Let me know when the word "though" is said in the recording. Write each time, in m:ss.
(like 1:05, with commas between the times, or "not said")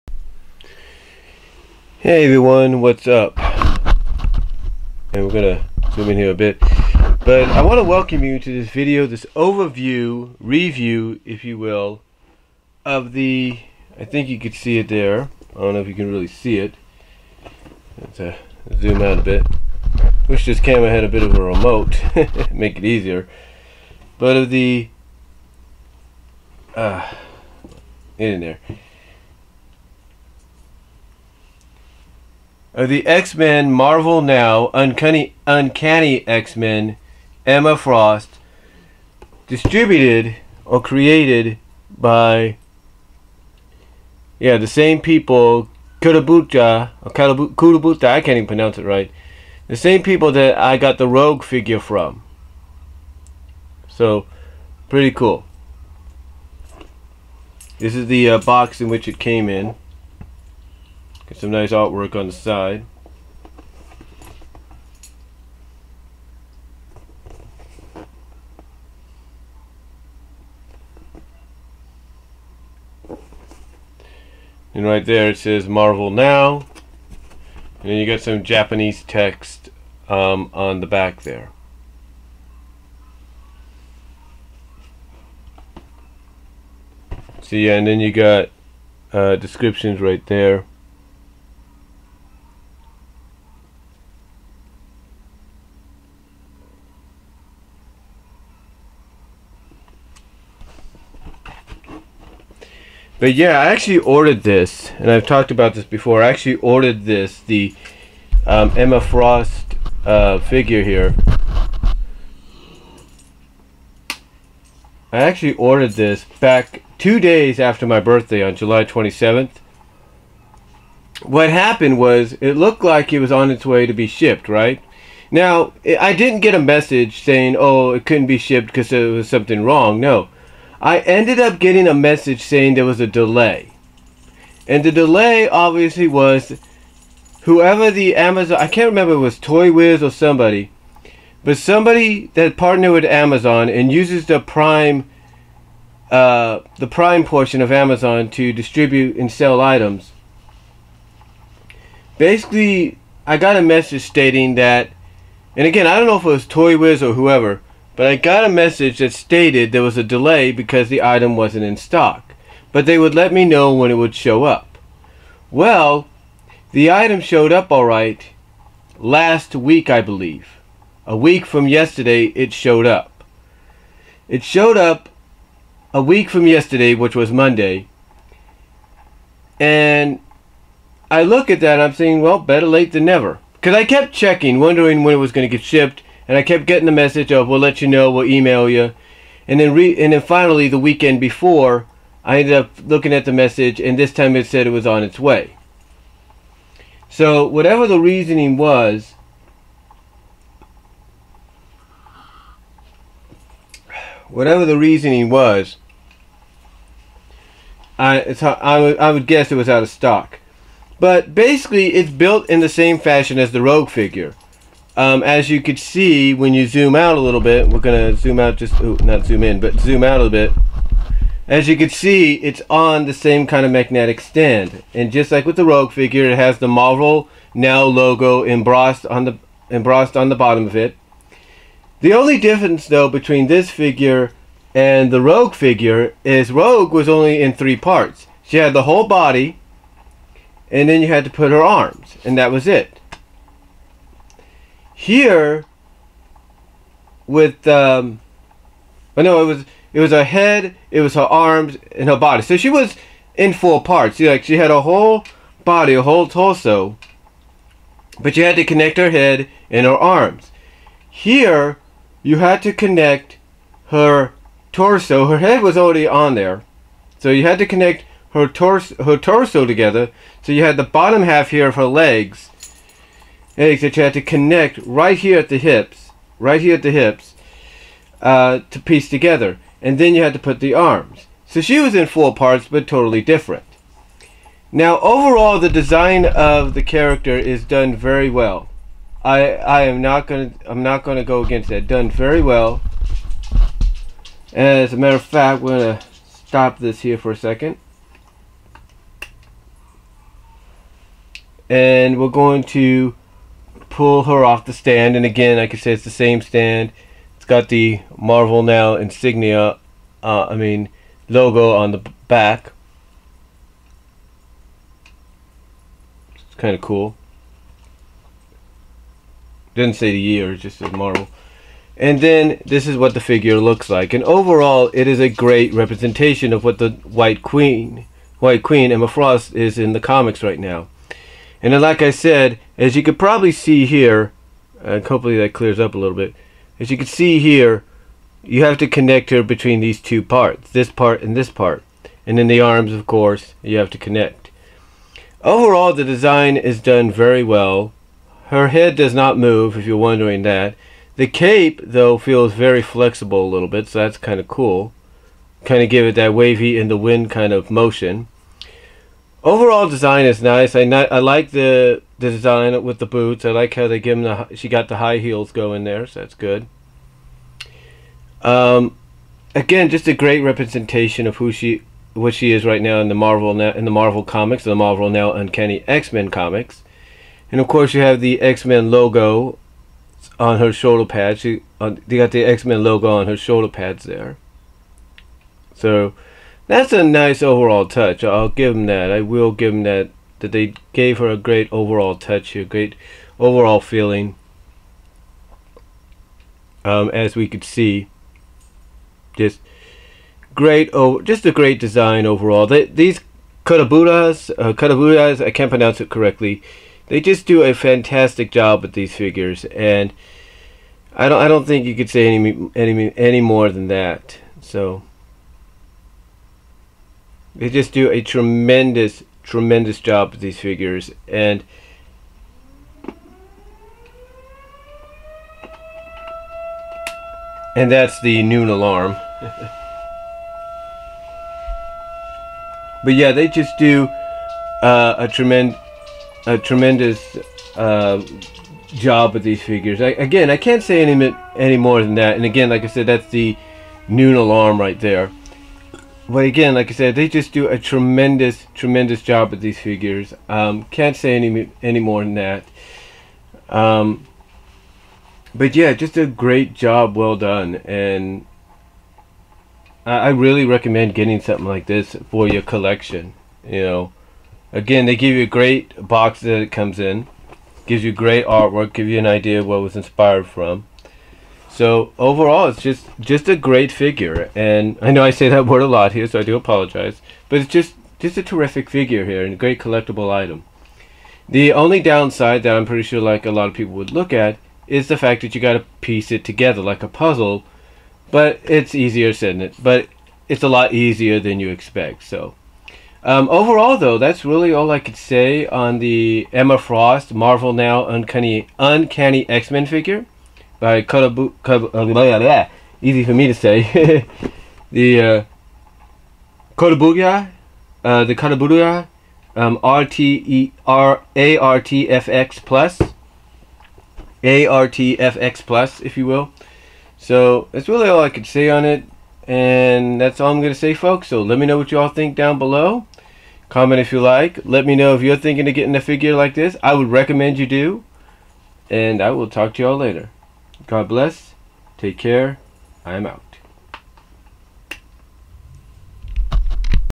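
3:52, 5:51, 8:13.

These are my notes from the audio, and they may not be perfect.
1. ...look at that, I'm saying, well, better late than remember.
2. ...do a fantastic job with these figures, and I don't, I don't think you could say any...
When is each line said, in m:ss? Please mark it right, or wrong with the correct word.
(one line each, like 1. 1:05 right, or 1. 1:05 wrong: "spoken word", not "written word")
1. 3:01 wrong: "never", not "remember"
2. 6:47 right.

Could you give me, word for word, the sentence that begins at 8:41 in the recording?
So let me know what you all think down below.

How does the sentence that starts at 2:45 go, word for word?
Well, the item showed up alright last week, I believe.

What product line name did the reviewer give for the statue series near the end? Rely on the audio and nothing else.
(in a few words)
ARTFX plus.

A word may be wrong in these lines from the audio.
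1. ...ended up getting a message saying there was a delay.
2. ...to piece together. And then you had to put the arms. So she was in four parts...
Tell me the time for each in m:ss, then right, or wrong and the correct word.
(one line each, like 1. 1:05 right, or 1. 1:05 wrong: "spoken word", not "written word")
1. 2:11 right
2. 4:38 right.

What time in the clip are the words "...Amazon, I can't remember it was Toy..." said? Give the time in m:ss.
2:18.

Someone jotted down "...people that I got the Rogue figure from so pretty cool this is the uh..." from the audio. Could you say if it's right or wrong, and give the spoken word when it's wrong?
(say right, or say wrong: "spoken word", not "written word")
right.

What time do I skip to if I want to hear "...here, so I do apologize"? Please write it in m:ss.
7:56.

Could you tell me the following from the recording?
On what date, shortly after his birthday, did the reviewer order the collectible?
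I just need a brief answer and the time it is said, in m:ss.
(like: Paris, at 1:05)
July 27th, at 1:58.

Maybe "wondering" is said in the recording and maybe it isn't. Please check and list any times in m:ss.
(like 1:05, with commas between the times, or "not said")
3:04, 5:49.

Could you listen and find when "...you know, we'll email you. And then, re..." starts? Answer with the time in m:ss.
3:07.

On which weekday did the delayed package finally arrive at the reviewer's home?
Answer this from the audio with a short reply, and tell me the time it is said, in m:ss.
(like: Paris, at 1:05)
Monday, at 2:57.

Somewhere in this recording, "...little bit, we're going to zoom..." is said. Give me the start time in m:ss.
3:37.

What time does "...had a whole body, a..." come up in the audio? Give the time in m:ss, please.
4:14.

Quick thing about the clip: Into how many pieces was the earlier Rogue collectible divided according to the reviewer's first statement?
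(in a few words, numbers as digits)
3.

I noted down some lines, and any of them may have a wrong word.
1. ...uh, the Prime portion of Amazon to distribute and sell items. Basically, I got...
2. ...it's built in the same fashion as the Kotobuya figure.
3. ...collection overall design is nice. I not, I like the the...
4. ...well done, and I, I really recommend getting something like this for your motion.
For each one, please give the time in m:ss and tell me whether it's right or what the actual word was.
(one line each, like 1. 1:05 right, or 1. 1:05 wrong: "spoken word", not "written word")
1. 2:26 right
2. 3:31 wrong: "Rogue", not "Kotobuya"
3. 5:57 wrong: "motion", not "collection"
4. 7:37 wrong: "collection", not "motion".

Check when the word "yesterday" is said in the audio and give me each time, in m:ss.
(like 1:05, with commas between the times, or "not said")
2:51, 2:56.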